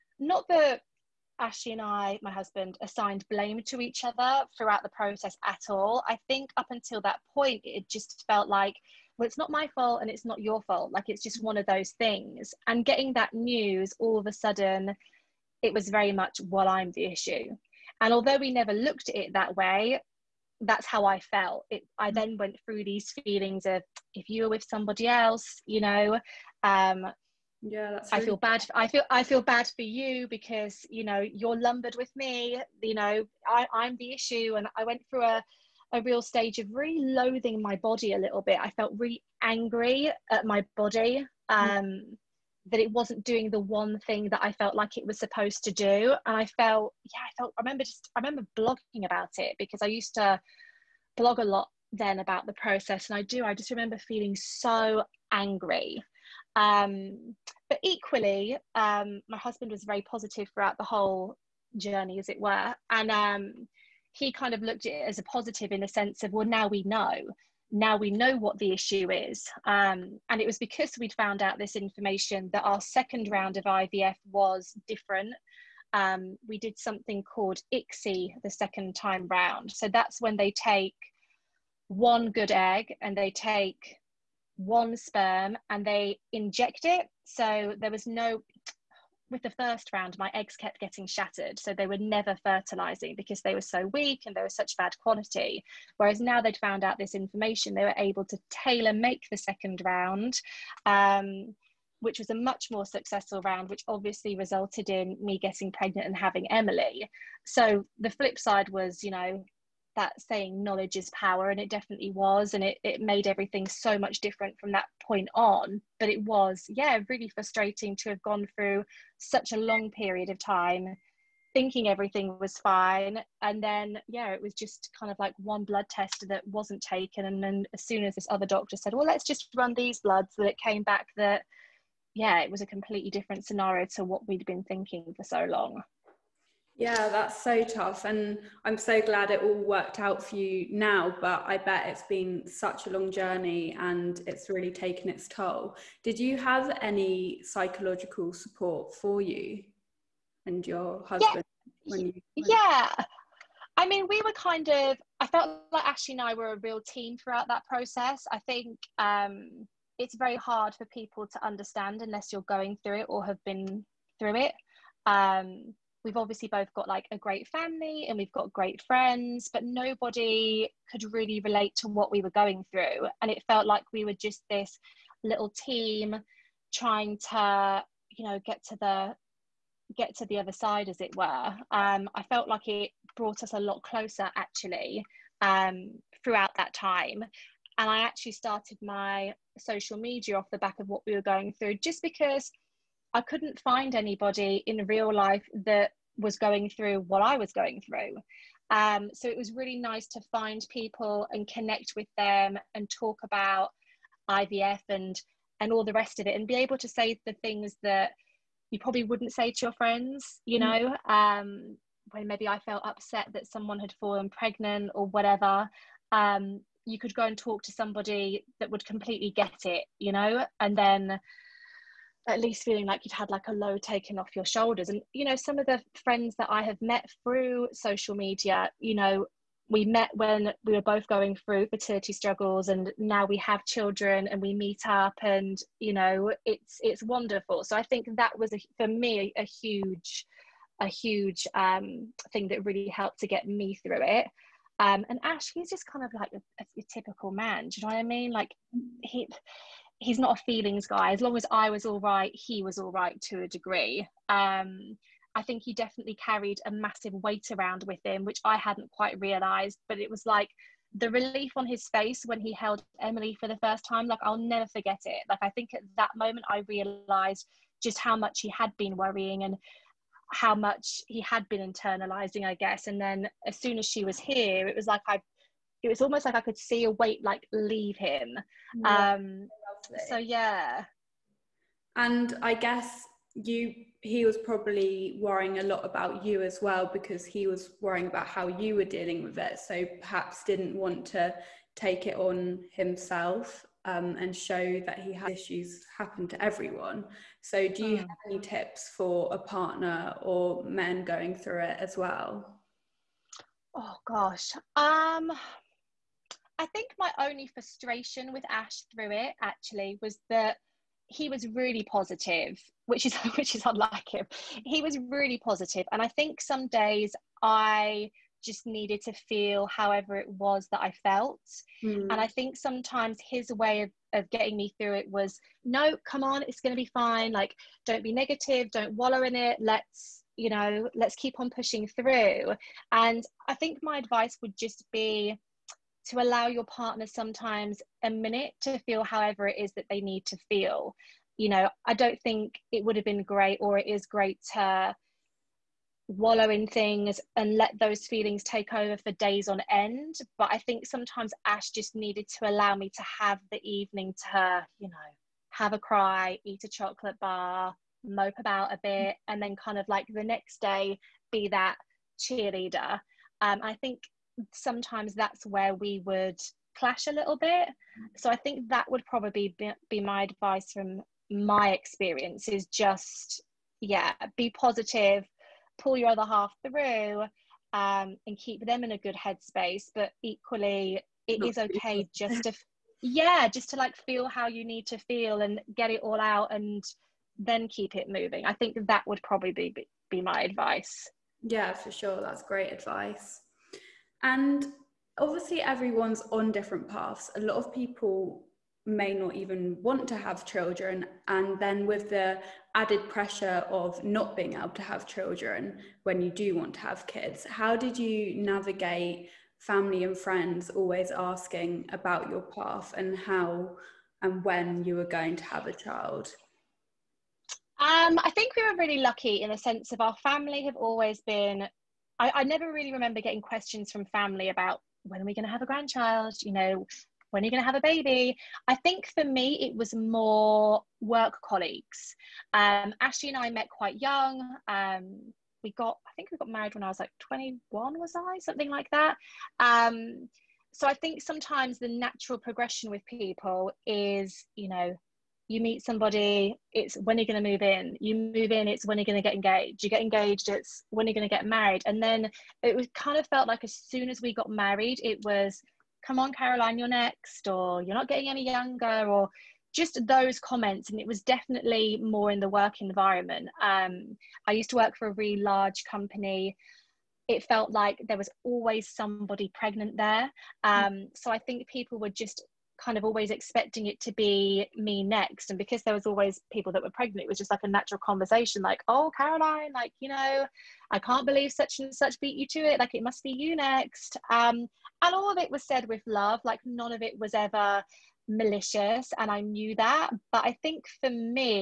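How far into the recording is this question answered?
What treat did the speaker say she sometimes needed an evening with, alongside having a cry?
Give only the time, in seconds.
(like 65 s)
356 s.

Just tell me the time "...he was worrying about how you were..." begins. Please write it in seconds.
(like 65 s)
287 s.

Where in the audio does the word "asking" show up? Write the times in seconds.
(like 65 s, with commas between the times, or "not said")
411 s.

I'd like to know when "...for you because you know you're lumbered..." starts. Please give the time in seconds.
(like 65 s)
29 s.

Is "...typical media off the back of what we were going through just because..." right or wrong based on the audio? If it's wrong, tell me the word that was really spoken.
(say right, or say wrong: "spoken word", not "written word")
wrong: "social", not "typical".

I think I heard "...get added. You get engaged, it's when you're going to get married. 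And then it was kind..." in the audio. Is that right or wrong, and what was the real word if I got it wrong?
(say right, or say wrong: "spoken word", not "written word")
wrong: "engaged", not "added".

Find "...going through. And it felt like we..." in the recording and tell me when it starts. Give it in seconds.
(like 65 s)
172 s.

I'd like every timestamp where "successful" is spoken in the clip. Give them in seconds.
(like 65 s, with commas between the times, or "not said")
102 s.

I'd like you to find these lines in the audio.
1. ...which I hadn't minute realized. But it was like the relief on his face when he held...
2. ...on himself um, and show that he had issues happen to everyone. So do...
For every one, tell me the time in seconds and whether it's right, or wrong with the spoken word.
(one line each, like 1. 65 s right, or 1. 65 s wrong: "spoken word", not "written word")
1. 258 s wrong: "quite", not "minute"
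2. 292 s right.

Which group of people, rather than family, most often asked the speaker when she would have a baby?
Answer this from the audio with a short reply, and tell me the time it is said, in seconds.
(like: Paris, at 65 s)
Work colleagues, at 431 s.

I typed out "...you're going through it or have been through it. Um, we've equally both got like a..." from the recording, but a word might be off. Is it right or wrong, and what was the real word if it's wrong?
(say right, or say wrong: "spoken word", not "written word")
wrong: "obviously", not "equally".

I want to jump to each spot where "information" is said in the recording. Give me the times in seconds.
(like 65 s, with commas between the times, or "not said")
71 s, 97 s.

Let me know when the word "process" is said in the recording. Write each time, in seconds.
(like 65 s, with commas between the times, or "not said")
4 s, 52 s, 157 s.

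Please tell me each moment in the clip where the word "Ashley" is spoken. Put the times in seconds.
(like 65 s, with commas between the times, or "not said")
1 s, 155 s, 433 s.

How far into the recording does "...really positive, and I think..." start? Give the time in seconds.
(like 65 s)
315 s.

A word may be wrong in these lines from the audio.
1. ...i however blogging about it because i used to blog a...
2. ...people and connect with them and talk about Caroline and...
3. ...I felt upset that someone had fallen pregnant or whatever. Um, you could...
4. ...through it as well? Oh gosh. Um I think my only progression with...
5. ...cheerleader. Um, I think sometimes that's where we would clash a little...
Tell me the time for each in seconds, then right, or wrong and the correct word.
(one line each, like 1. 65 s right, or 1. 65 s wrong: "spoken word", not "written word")
1. 48 s wrong: "remember", not "however"
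2. 200 s wrong: "IVF", not "Caroline"
3. 212 s right
4. 301 s wrong: "frustration", not "progression"
5. 362 s right.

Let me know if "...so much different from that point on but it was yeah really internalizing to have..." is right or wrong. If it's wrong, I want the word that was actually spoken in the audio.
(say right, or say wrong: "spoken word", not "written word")
wrong: "frustrating", not "internalizing".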